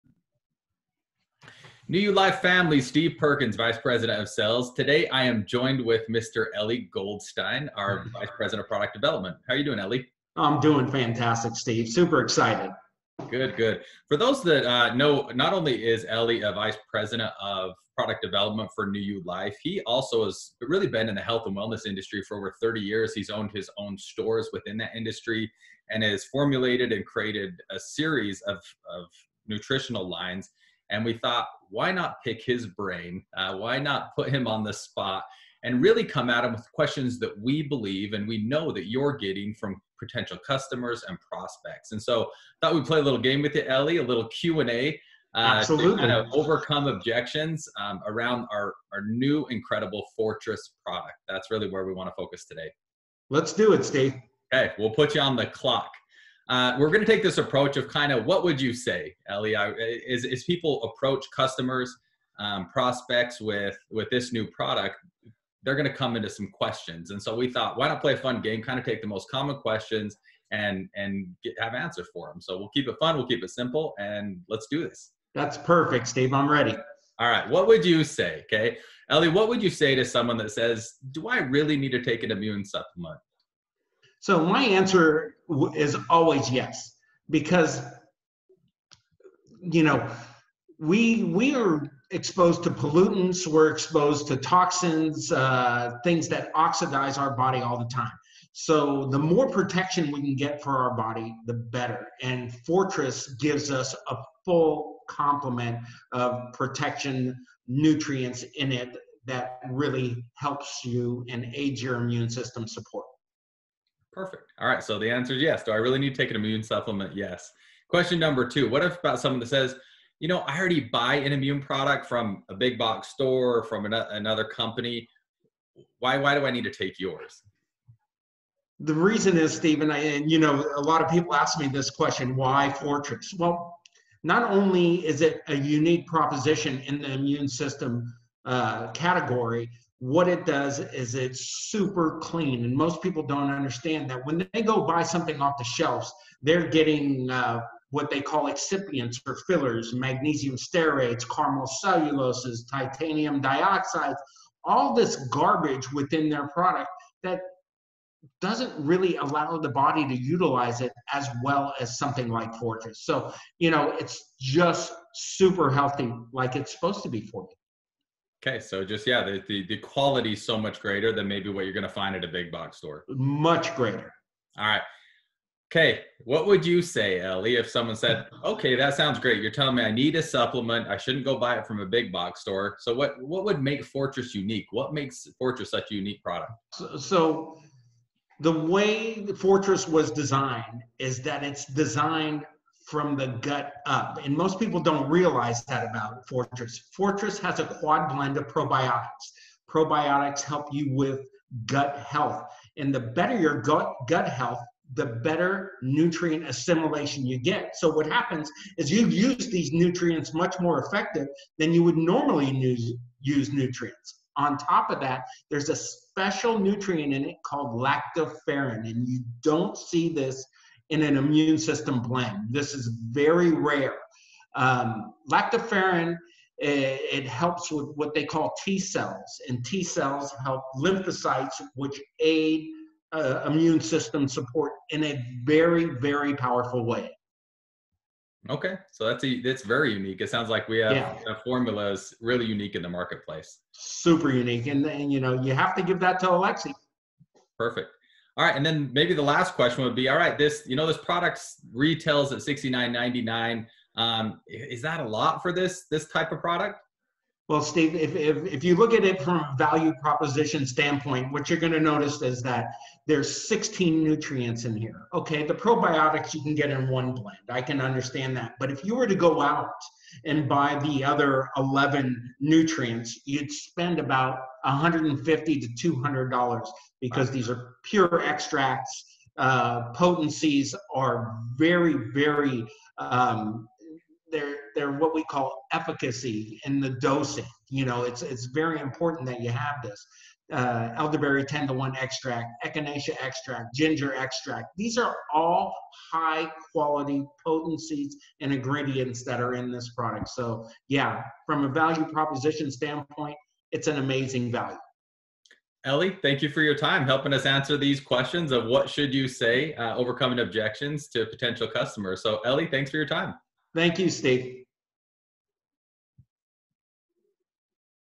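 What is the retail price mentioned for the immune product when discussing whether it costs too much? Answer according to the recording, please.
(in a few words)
$69.99.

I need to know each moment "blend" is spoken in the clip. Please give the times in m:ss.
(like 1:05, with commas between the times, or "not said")
3:18, 3:42, 4:27.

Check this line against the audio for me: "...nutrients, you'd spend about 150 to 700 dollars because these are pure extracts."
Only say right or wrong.
wrong.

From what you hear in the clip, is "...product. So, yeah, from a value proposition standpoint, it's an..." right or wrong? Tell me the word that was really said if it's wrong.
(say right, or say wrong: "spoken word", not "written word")
right.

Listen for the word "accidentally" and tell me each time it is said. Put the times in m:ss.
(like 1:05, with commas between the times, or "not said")
not said.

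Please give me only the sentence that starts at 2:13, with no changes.
Well, not only is it a unique proposition in the immune system uh, category, what it does is it's super clean.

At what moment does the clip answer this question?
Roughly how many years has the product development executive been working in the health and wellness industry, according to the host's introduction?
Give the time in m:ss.
0:22.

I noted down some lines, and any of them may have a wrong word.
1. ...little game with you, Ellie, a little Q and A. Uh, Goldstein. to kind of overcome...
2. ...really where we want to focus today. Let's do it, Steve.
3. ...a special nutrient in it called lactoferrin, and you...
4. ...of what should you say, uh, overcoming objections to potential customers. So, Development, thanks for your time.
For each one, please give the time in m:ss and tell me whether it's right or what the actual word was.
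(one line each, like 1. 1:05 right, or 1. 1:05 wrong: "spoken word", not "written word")
1. 0:43 wrong: "Absolutely", not "Goldstein"
2. 0:51 right
3. 3:35 right
4. 5:08 wrong: "Ellie", not "Development".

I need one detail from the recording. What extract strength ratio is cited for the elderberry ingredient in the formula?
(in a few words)
10 to 1.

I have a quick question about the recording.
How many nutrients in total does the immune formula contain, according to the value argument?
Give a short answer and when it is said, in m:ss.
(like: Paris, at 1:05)
16, at 4:23.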